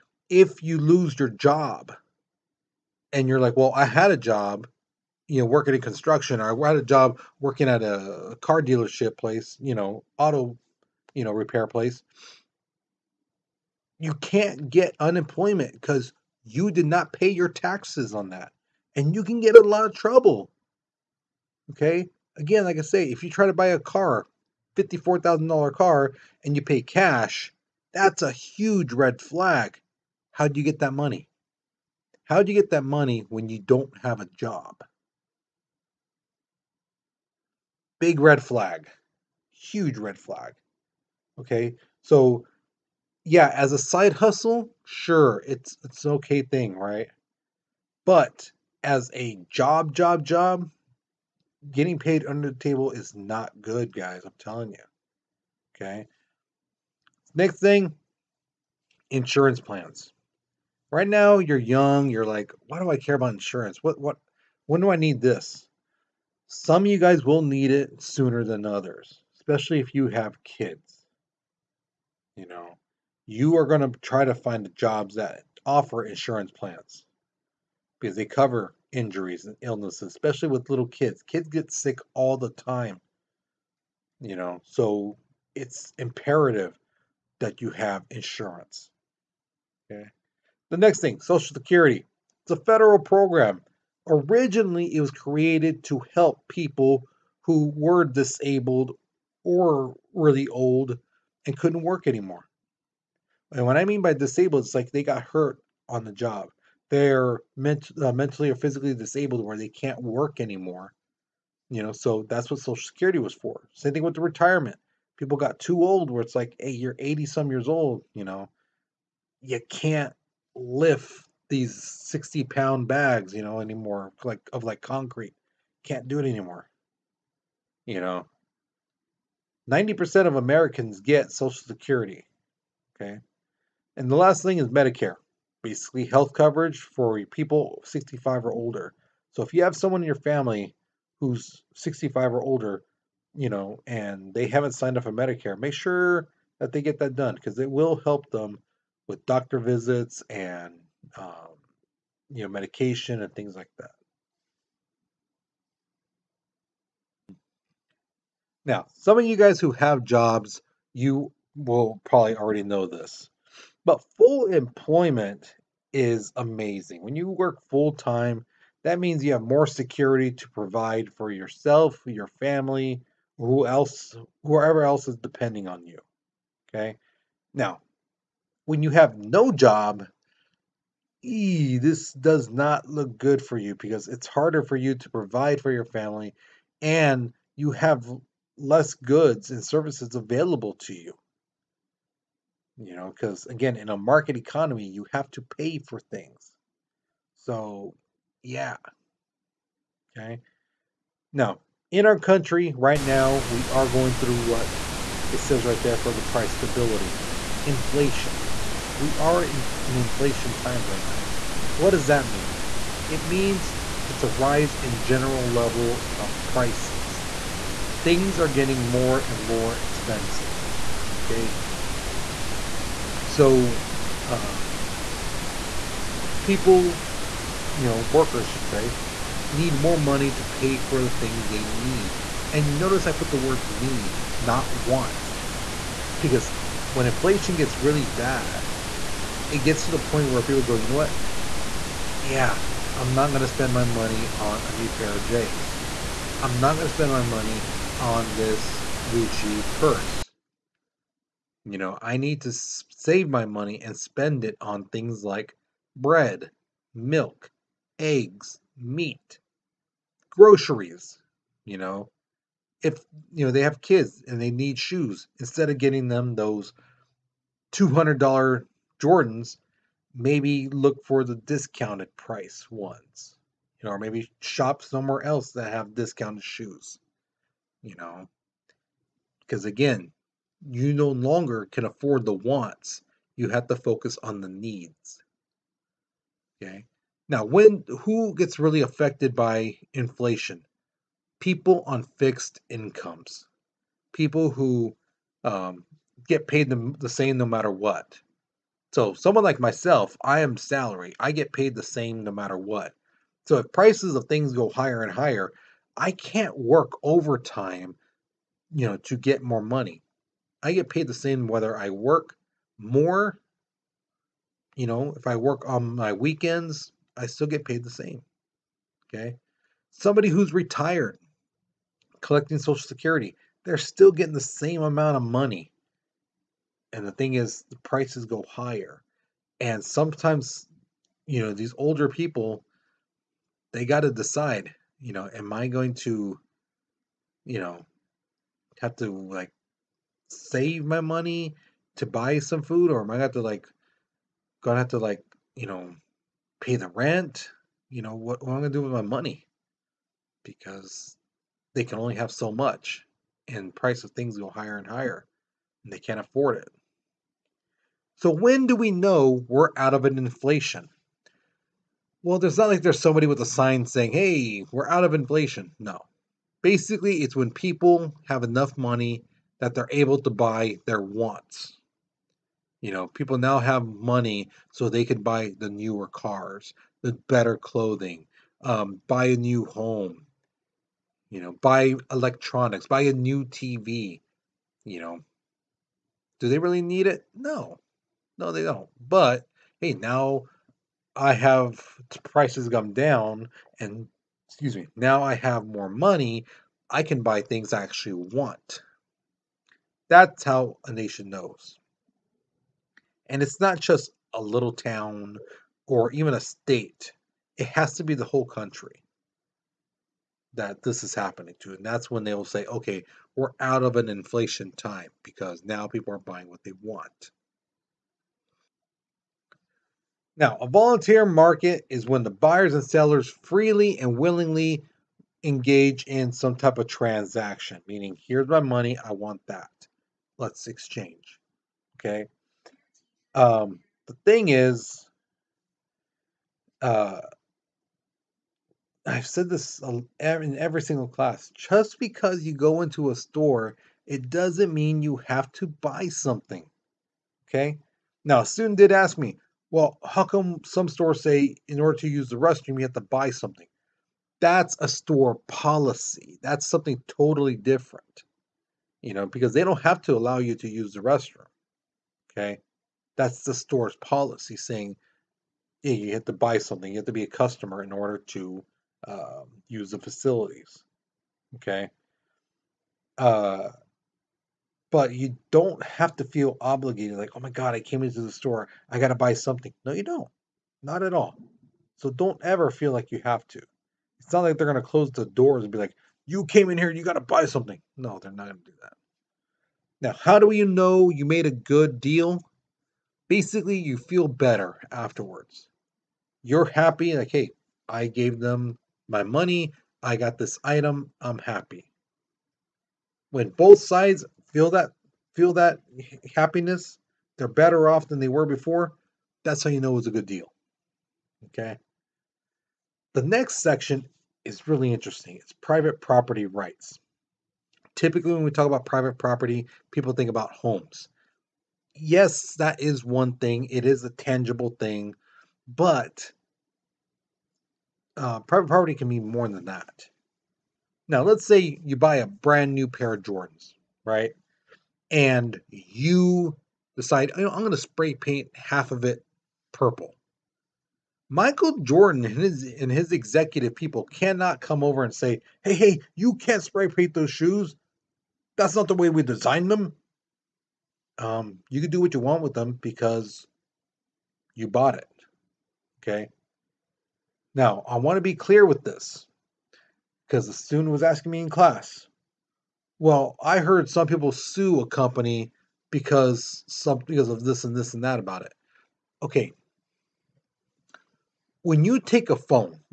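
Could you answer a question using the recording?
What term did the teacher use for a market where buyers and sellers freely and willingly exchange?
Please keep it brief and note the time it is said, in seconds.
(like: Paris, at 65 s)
volunteer market, at 420 s.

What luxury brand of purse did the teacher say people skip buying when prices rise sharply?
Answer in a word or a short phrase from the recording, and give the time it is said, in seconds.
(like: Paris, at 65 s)
Gucci, at 249 s.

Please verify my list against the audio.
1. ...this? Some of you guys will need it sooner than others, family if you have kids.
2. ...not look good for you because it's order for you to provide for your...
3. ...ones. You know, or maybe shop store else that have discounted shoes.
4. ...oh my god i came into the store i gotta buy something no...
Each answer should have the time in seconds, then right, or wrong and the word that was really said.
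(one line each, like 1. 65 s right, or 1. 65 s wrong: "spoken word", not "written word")
1. 65 s wrong: "especially", not "family"
2. 182 s wrong: "harder", not "order"
3. 272 s wrong: "somewhere", not "store"
4. 477 s right.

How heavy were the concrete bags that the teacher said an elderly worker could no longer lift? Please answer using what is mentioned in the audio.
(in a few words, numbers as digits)
60 pounds.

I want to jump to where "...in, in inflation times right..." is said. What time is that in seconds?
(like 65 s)
209 s.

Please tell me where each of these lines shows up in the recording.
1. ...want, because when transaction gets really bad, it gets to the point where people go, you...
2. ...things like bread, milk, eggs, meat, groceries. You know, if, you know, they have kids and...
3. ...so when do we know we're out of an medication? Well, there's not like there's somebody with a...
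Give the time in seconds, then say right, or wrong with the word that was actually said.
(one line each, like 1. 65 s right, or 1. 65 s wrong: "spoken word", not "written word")
1. 234 s wrong: "inflation", not "transaction"
2. 254 s right
3. 358 s wrong: "inflation", not "medication".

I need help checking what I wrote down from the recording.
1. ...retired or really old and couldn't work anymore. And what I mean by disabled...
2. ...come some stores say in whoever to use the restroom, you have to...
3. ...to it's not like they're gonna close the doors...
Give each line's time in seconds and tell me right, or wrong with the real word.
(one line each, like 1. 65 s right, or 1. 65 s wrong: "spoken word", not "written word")
1. 98 s wrong: "disabled", not "retired"
2. 450 s wrong: "order", not "whoever"
3. 483 s right.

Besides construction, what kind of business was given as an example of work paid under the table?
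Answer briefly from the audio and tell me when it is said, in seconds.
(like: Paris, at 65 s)
car dealership, at 8 s.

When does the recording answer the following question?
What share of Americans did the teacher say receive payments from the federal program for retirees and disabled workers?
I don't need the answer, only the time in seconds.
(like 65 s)
129 s.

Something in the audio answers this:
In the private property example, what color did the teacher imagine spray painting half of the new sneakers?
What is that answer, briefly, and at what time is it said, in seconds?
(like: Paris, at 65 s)
purple, at 539 s.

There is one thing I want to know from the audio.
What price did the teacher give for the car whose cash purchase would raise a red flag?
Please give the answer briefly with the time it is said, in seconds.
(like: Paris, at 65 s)
$54,000, at 24 s.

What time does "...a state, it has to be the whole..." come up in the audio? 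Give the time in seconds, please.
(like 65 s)
406 s.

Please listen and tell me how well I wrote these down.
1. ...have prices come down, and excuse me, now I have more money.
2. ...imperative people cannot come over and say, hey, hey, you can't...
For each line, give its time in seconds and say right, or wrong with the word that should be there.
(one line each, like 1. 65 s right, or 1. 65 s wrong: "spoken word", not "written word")
1. 391 s right
2. 543 s wrong: "executive", not "imperative".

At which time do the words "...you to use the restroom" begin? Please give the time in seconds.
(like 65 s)
460 s.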